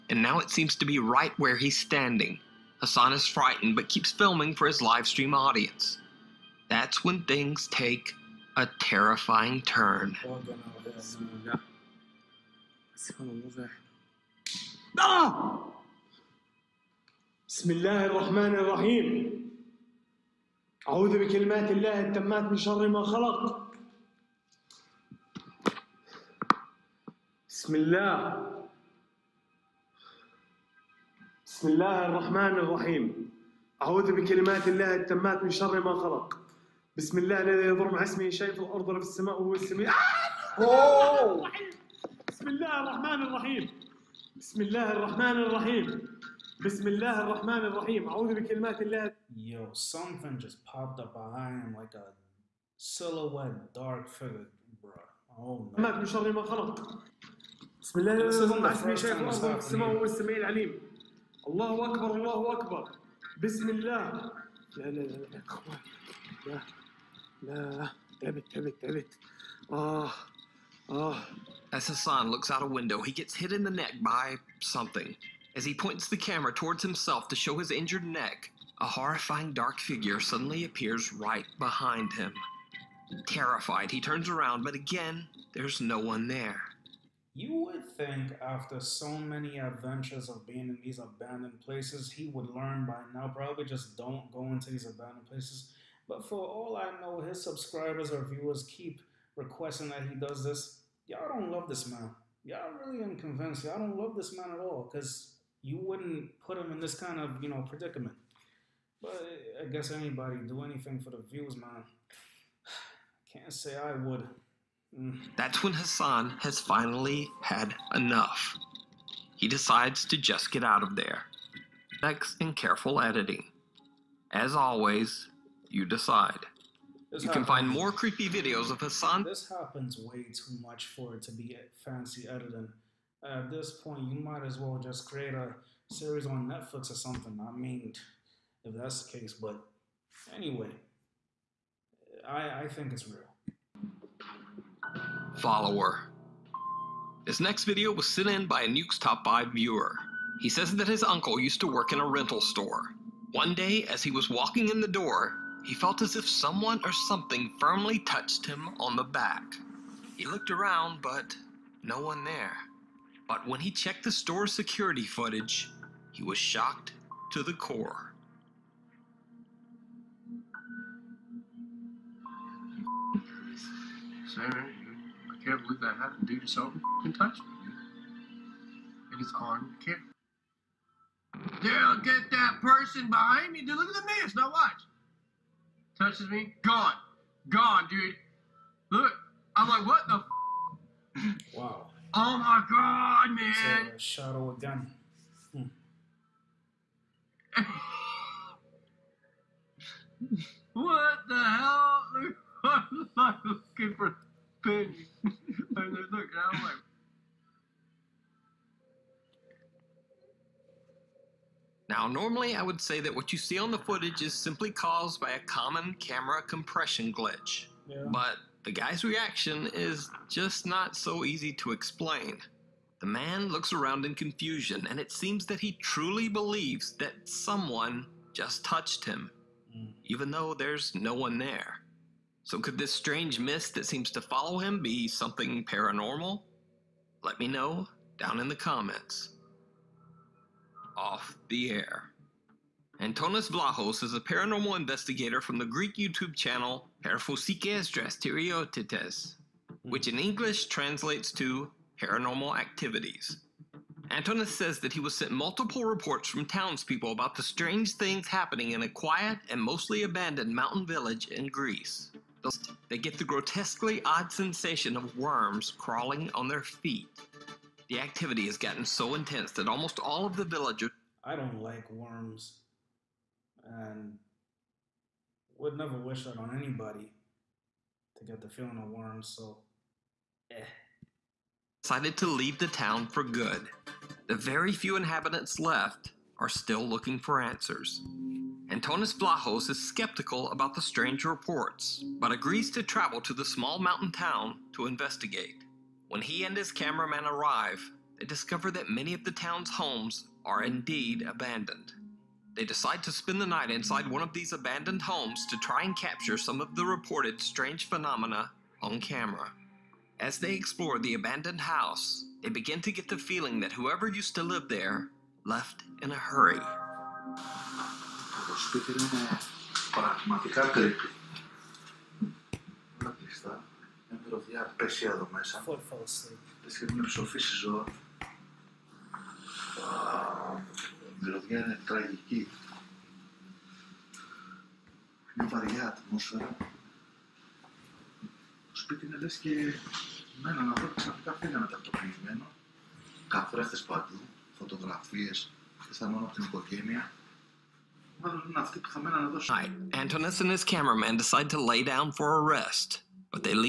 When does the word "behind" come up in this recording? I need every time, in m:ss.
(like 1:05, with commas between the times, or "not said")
0:51, 1:21, 3:03.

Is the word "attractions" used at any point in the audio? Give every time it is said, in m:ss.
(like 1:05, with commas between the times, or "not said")
not said.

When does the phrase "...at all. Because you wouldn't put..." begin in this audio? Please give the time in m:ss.
1:44.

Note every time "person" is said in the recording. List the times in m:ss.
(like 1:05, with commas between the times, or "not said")
3:02.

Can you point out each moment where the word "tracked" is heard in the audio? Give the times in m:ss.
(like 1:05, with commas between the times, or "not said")
not said.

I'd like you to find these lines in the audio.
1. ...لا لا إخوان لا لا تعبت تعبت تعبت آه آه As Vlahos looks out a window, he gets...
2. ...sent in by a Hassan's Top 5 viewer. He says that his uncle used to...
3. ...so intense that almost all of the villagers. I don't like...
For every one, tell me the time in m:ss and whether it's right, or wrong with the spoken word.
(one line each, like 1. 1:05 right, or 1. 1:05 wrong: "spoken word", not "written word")
1. 1:04 wrong: "Hassan", not "Vlahos"
2. 2:28 wrong: "Nuke", not "Hassan"
3. 4:28 right.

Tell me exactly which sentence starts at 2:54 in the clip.
Sorry, I can't believe that happened.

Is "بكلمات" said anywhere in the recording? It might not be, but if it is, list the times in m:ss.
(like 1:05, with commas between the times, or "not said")
0:21, 0:34, 0:48.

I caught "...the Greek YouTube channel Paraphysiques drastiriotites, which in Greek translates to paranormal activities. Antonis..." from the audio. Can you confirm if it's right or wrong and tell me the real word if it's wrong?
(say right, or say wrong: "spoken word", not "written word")
wrong: "English", not "Greek".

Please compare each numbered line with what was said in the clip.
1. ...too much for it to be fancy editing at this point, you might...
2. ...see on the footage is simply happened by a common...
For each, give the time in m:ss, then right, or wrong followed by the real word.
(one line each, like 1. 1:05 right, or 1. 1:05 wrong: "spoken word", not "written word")
1. 2:10 right
2. 3:33 wrong: "caused", not "happened".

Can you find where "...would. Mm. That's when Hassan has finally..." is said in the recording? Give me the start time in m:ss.
1:53.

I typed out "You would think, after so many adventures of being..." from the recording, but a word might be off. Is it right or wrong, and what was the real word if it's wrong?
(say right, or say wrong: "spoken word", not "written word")
right.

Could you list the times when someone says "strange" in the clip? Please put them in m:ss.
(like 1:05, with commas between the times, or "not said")
3:52, 4:17, 4:50, 5:07.